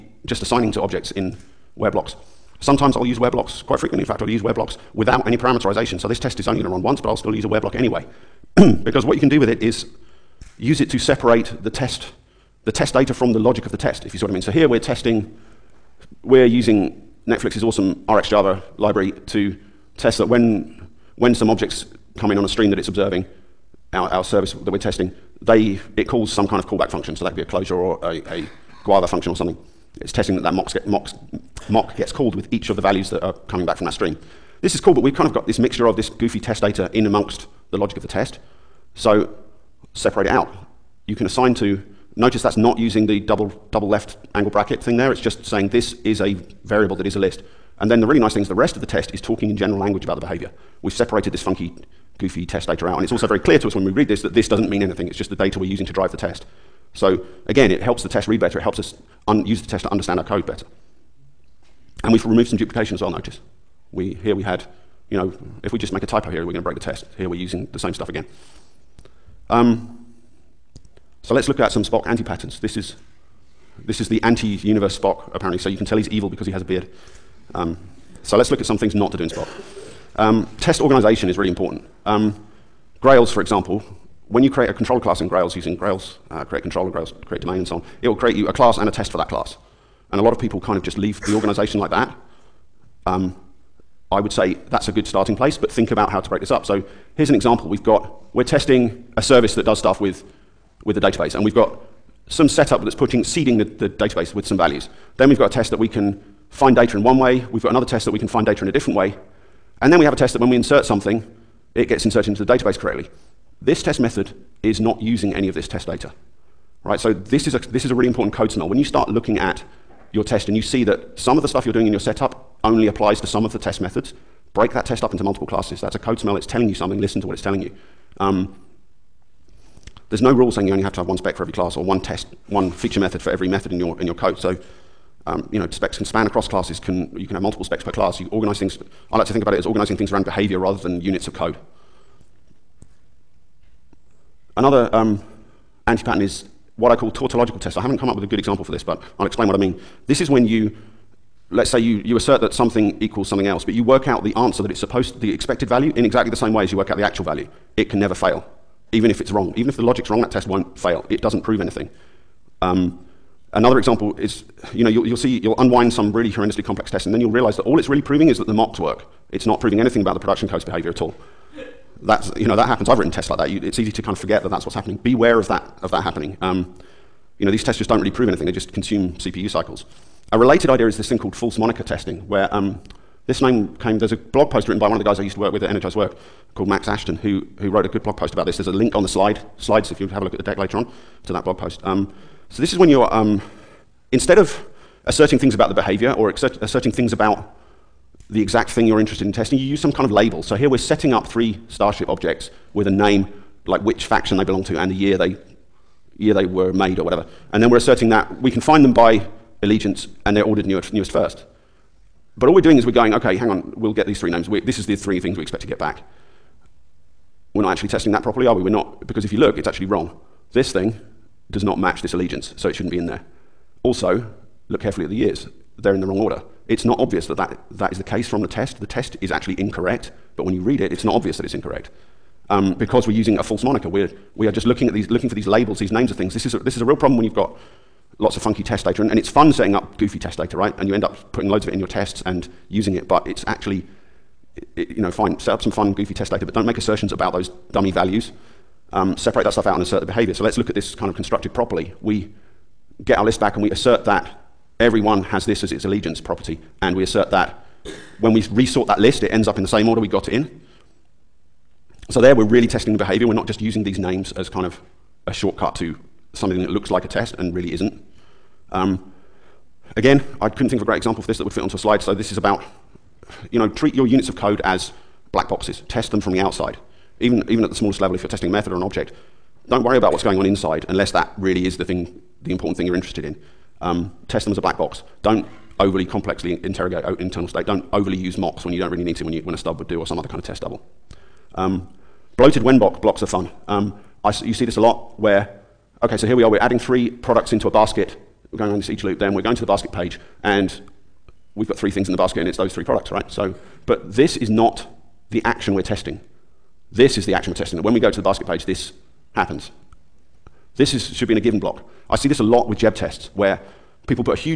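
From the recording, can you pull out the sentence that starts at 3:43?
Also, look carefully at the years.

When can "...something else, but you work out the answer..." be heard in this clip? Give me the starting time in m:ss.
2:33.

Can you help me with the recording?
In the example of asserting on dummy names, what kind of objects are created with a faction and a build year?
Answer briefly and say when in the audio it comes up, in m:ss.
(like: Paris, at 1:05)
Starship objects, at 3:21.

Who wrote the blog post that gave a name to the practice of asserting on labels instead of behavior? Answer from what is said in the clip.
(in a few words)
Max Ashton.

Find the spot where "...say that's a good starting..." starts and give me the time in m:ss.
1:34.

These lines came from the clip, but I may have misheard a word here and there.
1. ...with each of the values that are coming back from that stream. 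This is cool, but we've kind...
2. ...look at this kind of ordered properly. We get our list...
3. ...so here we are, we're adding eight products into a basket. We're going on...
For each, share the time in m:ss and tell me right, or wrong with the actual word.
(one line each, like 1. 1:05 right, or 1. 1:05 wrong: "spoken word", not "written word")
1. 0:32 right
2. 4:10 wrong: "constructed", not "ordered"
3. 4:56 wrong: "three", not "eight".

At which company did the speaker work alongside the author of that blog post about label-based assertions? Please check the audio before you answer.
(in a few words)
Energized Work.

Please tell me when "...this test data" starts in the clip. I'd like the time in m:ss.
1:55.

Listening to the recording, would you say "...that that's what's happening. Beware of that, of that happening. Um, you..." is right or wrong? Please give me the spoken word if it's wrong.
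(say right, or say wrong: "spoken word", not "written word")
right.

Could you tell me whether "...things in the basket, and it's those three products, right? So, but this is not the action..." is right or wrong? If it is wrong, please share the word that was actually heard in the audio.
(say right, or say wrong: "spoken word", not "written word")
right.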